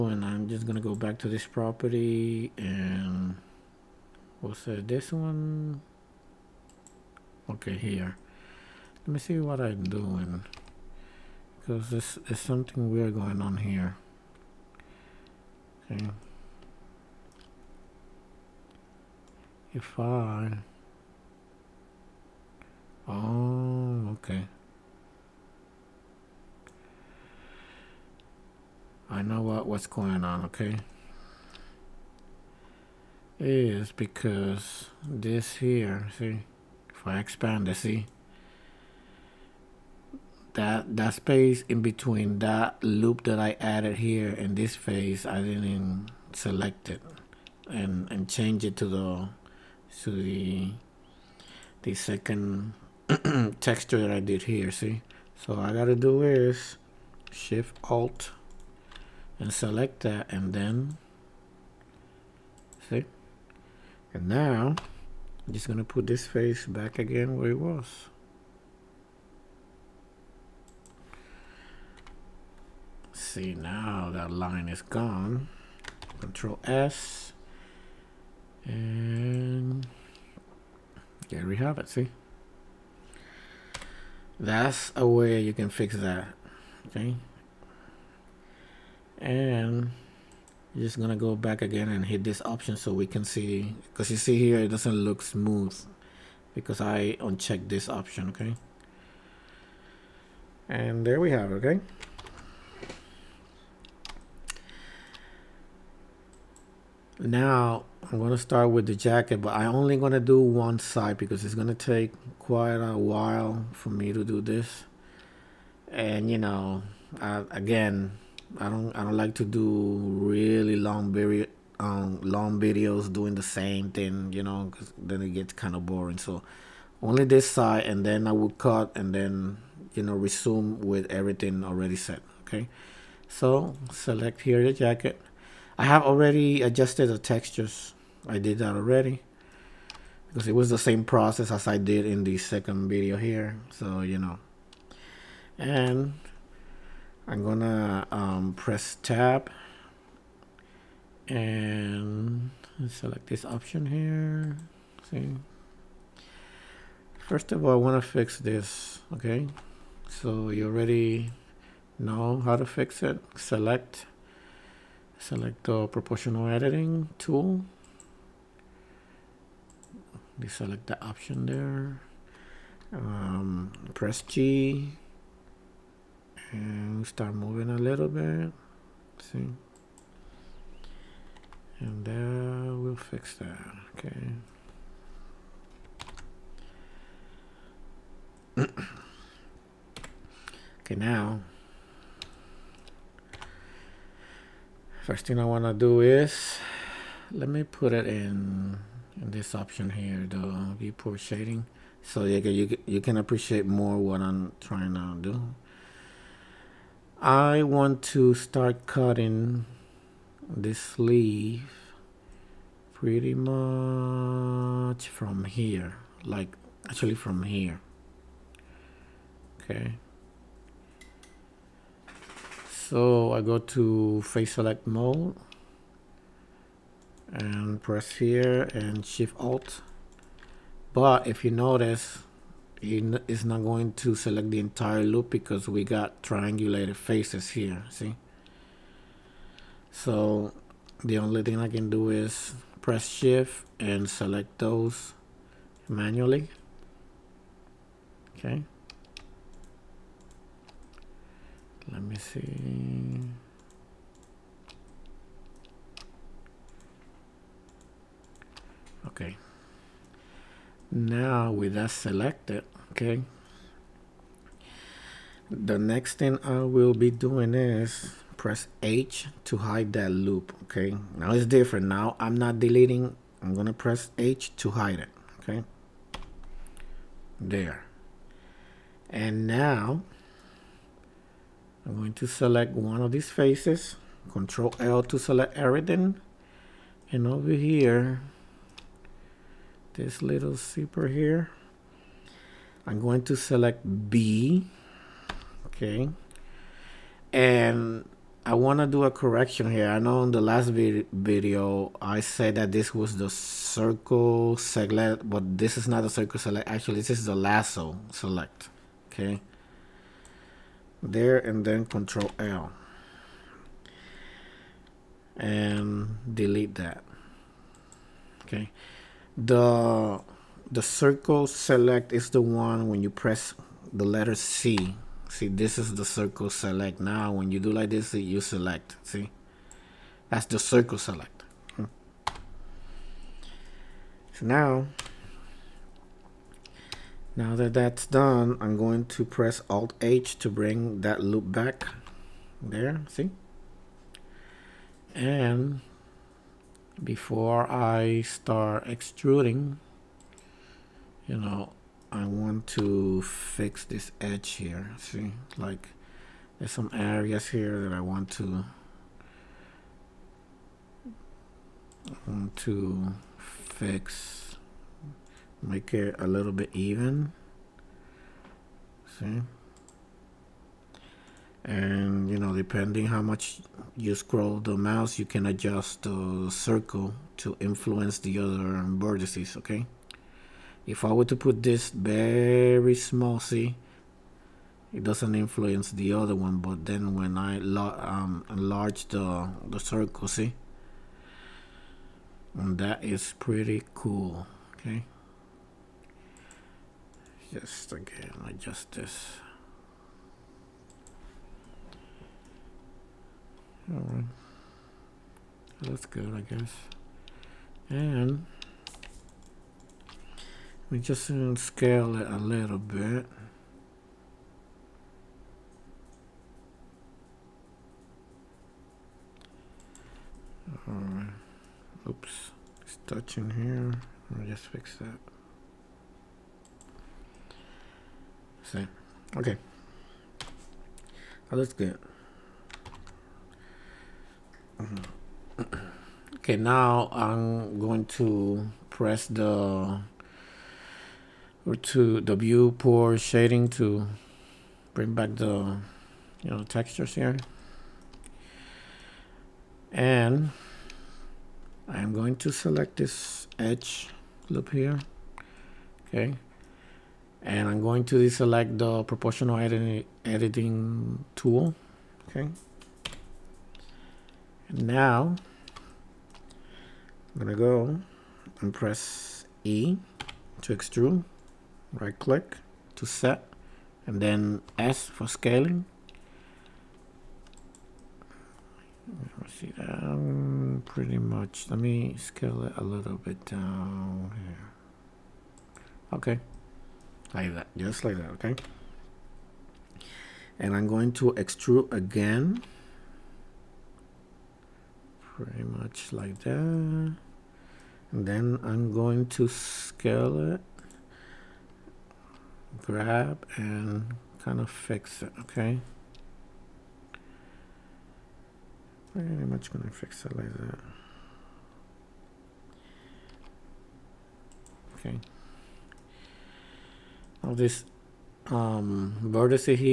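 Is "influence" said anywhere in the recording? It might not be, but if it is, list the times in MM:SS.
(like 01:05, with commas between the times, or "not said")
06:17, 06:25.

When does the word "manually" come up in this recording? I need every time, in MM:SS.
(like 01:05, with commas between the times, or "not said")
04:05.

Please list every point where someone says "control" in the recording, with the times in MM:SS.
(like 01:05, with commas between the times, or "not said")
01:16, 04:44, 05:11.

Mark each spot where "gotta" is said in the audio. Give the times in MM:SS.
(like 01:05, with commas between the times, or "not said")
00:55.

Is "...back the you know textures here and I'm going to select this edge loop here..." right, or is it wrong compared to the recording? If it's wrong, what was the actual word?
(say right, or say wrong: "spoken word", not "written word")
right.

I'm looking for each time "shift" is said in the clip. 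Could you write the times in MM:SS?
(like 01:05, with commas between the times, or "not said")
00:57, 03:49, 04:03.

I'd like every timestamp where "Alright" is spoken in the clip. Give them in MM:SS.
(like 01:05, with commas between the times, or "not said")
06:43, 07:00.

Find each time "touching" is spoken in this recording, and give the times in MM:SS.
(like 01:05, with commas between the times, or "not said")
07:03.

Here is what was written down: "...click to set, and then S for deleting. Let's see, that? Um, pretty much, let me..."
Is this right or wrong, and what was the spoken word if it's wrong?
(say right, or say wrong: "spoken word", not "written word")
wrong: "scaling", not "deleting".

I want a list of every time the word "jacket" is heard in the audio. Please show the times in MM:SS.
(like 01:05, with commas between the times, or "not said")
01:48, 02:14.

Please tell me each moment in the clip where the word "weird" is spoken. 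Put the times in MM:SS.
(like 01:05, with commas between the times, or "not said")
00:12.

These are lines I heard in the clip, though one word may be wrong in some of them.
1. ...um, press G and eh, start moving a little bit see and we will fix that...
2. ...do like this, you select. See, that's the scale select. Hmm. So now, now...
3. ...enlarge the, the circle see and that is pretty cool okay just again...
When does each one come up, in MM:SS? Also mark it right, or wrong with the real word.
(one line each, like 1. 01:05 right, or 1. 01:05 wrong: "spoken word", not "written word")
1. 02:52 right
2. 05:27 wrong: "circle", not "scale"
3. 06:28 right.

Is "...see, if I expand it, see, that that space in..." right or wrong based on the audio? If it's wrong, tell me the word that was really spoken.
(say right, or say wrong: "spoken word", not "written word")
right.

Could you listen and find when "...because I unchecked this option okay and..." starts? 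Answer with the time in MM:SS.
01:36.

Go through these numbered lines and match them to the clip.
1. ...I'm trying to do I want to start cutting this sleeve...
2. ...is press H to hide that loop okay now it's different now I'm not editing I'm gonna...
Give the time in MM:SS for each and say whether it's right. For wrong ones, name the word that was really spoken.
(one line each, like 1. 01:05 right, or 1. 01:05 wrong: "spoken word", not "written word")
1. 03:24 right
2. 04:27 wrong: "deleting", not "editing".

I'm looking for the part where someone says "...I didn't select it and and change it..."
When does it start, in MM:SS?
00:45.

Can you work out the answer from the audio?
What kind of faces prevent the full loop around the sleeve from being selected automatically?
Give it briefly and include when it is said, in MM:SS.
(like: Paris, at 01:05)
Triangulated faces, at 03:56.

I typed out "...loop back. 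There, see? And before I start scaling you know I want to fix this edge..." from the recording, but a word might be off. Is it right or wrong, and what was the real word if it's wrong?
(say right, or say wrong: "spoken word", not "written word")
wrong: "extruding", not "scaling".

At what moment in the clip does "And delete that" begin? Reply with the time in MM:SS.
05:15.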